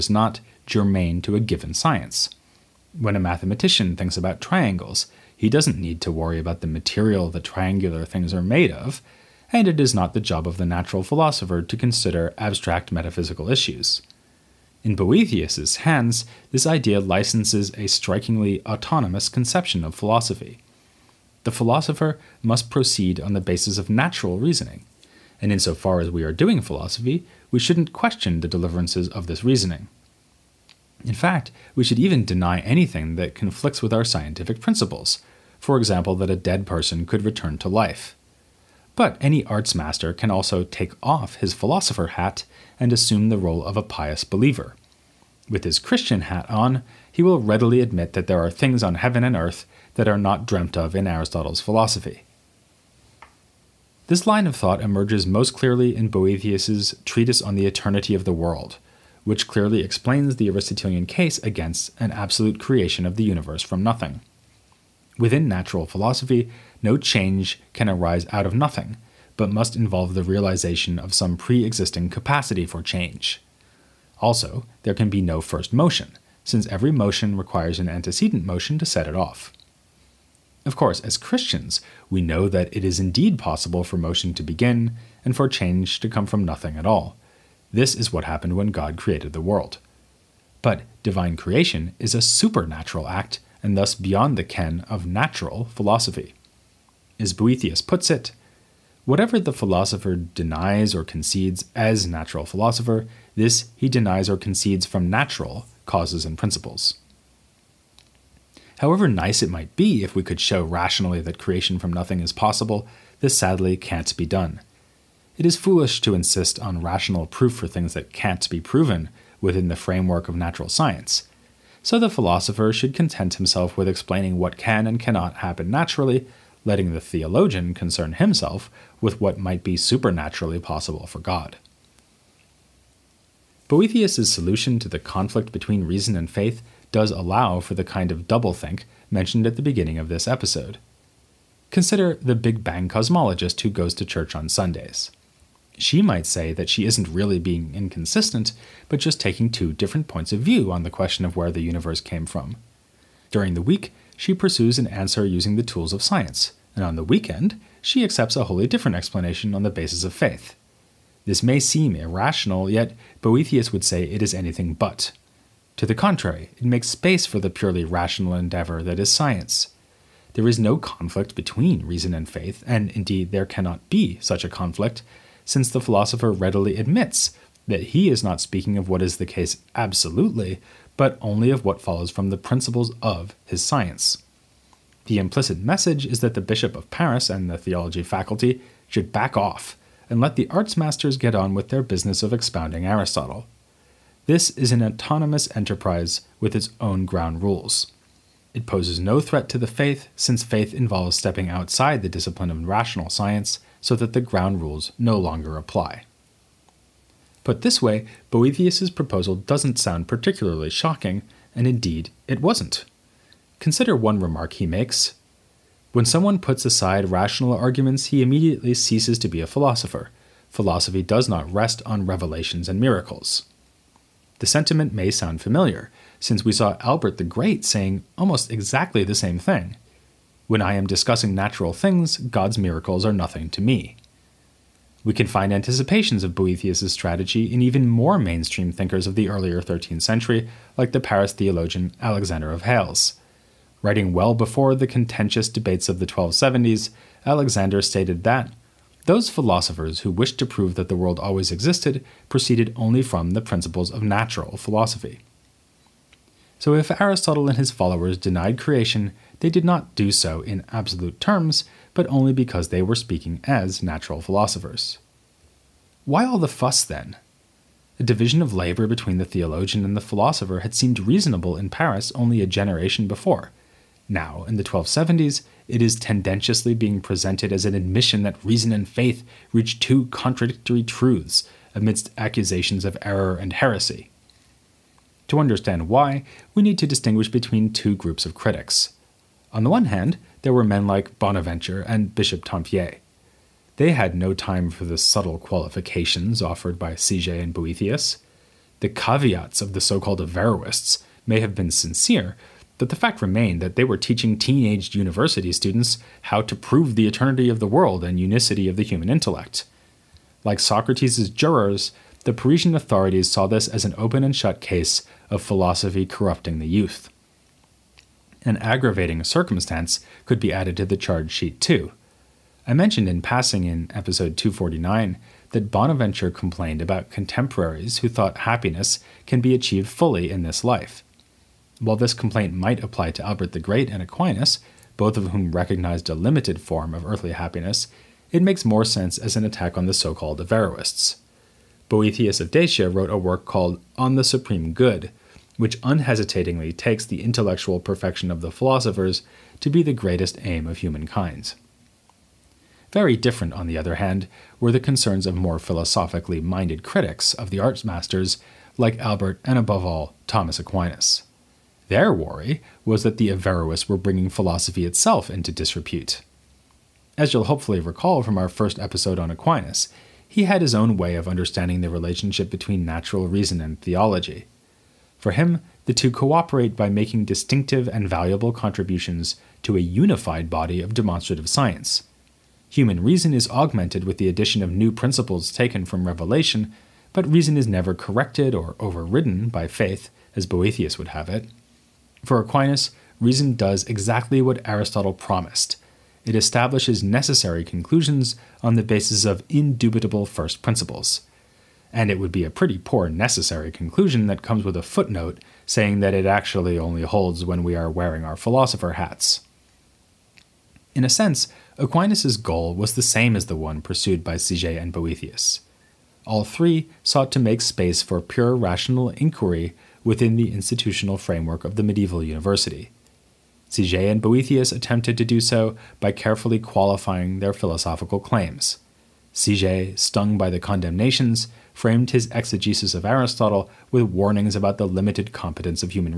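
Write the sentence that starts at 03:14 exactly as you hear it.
This is an autonomous enterprise with its own ground rules.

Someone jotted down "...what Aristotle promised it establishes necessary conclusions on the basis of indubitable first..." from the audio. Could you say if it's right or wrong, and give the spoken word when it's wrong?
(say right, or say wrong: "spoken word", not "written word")
right.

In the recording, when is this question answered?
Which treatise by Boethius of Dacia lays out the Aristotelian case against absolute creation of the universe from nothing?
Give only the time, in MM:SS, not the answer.
00:57.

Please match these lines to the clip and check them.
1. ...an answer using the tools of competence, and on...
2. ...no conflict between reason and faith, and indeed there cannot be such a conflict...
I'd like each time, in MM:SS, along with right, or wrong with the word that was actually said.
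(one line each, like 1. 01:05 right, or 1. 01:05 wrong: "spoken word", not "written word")
1. 02:34 wrong: "science", not "competence"
2. 02:50 right.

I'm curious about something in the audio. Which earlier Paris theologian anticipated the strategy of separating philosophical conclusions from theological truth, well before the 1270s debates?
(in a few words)
Alexander of Hales.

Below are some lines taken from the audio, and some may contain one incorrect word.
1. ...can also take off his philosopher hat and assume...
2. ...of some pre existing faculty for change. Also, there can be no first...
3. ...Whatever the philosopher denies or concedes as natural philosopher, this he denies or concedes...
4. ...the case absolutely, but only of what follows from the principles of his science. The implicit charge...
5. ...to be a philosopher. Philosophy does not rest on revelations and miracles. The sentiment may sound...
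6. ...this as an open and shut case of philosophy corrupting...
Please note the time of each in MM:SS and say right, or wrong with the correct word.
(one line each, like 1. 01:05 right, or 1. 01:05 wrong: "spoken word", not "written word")
1. 00:40 right
2. 01:10 wrong: "capacity", not "faculty"
3. 01:39 right
4. 02:59 wrong: "message", not "charge"
5. 03:39 right
6. 05:13 right.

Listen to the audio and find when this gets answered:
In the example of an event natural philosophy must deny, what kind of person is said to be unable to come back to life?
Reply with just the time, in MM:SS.
00:36.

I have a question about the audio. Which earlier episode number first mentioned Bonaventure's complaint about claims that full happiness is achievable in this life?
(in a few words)
249.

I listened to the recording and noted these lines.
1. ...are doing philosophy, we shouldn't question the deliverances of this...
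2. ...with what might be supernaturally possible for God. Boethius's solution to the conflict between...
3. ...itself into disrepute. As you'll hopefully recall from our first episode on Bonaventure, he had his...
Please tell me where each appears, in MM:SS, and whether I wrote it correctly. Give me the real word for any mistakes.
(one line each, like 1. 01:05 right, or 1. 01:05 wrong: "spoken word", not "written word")
1. 00:26 right
2. 02:09 right
3. 06:04 wrong: "Aquinas", not "Bonaventure".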